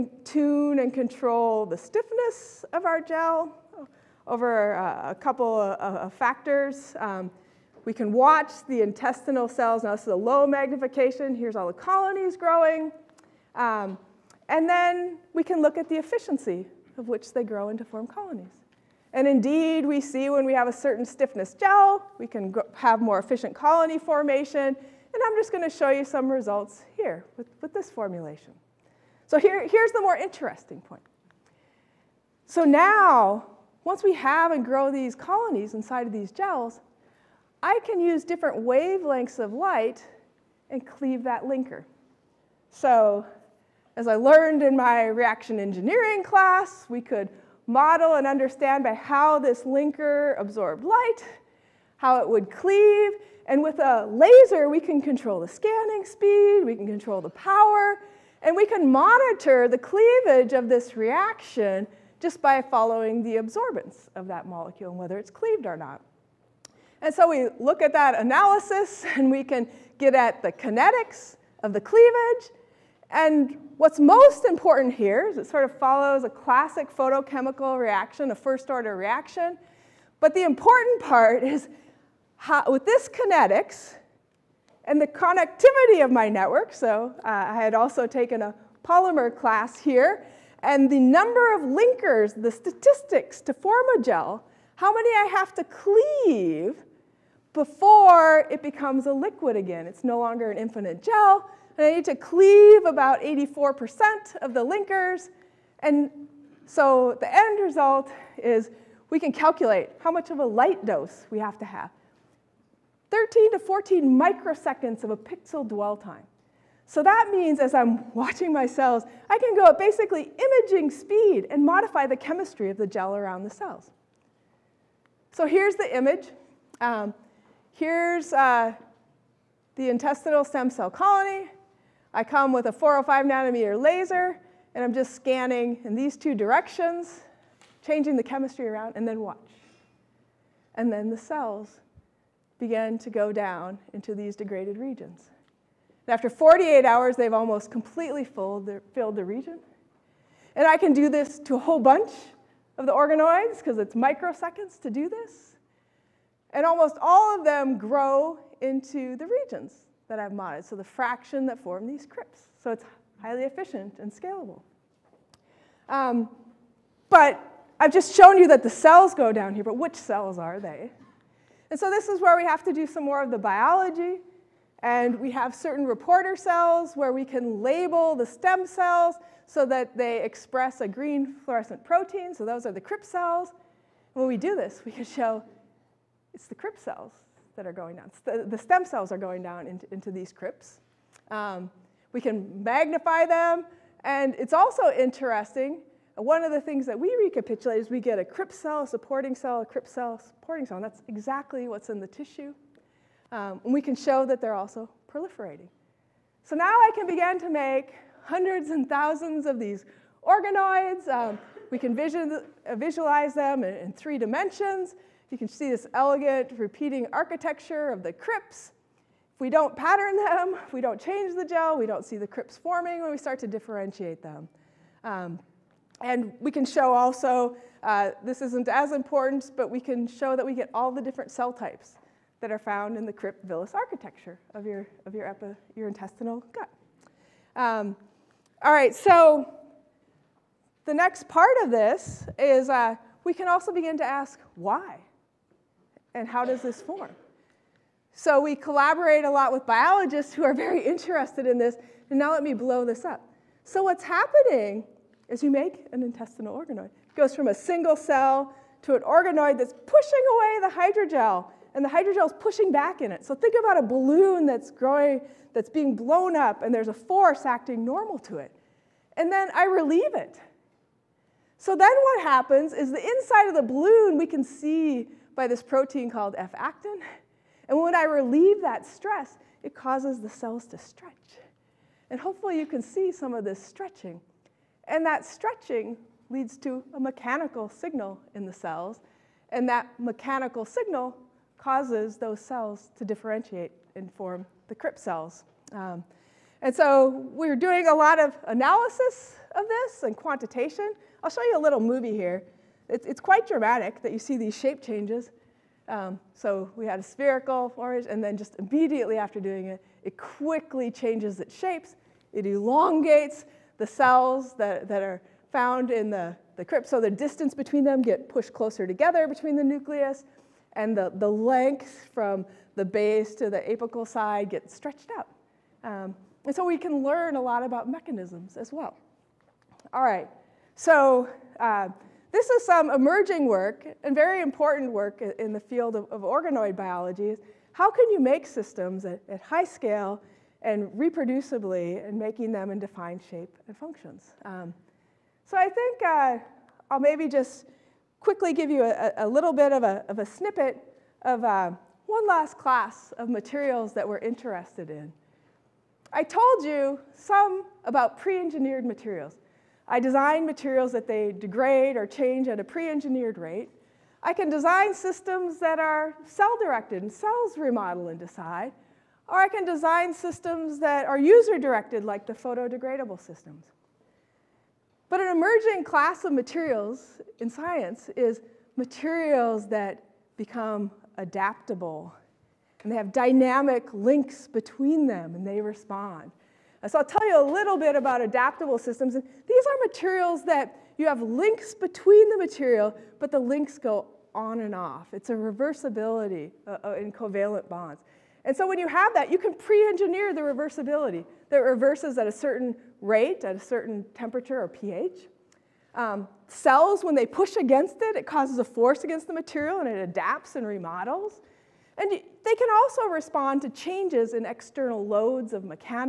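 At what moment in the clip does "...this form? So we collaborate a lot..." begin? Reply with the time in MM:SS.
04:06.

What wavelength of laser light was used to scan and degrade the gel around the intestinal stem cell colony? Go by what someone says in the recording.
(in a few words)
405 nanometers.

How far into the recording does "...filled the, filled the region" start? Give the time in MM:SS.
02:28.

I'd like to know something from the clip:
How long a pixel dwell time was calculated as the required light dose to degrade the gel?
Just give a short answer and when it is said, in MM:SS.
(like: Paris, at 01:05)
13 to 14 microseconds, at 01:53.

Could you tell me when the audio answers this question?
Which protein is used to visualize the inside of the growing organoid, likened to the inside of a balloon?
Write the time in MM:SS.
04:36.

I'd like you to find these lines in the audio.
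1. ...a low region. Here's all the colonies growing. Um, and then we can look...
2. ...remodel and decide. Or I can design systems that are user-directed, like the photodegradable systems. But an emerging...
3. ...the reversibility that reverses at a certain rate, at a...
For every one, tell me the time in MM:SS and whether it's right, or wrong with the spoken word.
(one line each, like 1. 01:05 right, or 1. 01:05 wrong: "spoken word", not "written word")
1. 00:10 wrong: "magnification", not "region"
2. 06:07 right
3. 06:40 right.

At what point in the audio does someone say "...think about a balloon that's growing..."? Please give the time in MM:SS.
04:23.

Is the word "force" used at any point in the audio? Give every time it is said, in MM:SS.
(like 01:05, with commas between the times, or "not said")
04:26, 06:48.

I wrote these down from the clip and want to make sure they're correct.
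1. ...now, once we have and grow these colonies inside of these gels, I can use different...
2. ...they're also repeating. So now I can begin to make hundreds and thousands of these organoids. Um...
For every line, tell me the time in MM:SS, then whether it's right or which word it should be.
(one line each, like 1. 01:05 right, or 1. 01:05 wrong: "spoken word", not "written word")
1. 00:32 right
2. 03:24 wrong: "proliferating", not "repeating".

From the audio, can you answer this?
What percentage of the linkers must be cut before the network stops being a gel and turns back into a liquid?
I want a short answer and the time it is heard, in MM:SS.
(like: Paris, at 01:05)
84%, at 01:43.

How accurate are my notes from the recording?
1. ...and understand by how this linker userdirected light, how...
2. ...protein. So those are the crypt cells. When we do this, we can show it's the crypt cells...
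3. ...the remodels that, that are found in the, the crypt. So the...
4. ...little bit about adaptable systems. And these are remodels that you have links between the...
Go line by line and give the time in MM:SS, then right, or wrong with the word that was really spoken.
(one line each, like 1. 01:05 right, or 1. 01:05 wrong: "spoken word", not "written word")
1. 00:48 wrong: "absorbed", not "userdirected"
2. 03:01 right
3. 05:13 wrong: "cells", not "remodels"
4. 06:27 wrong: "materials", not "remodels".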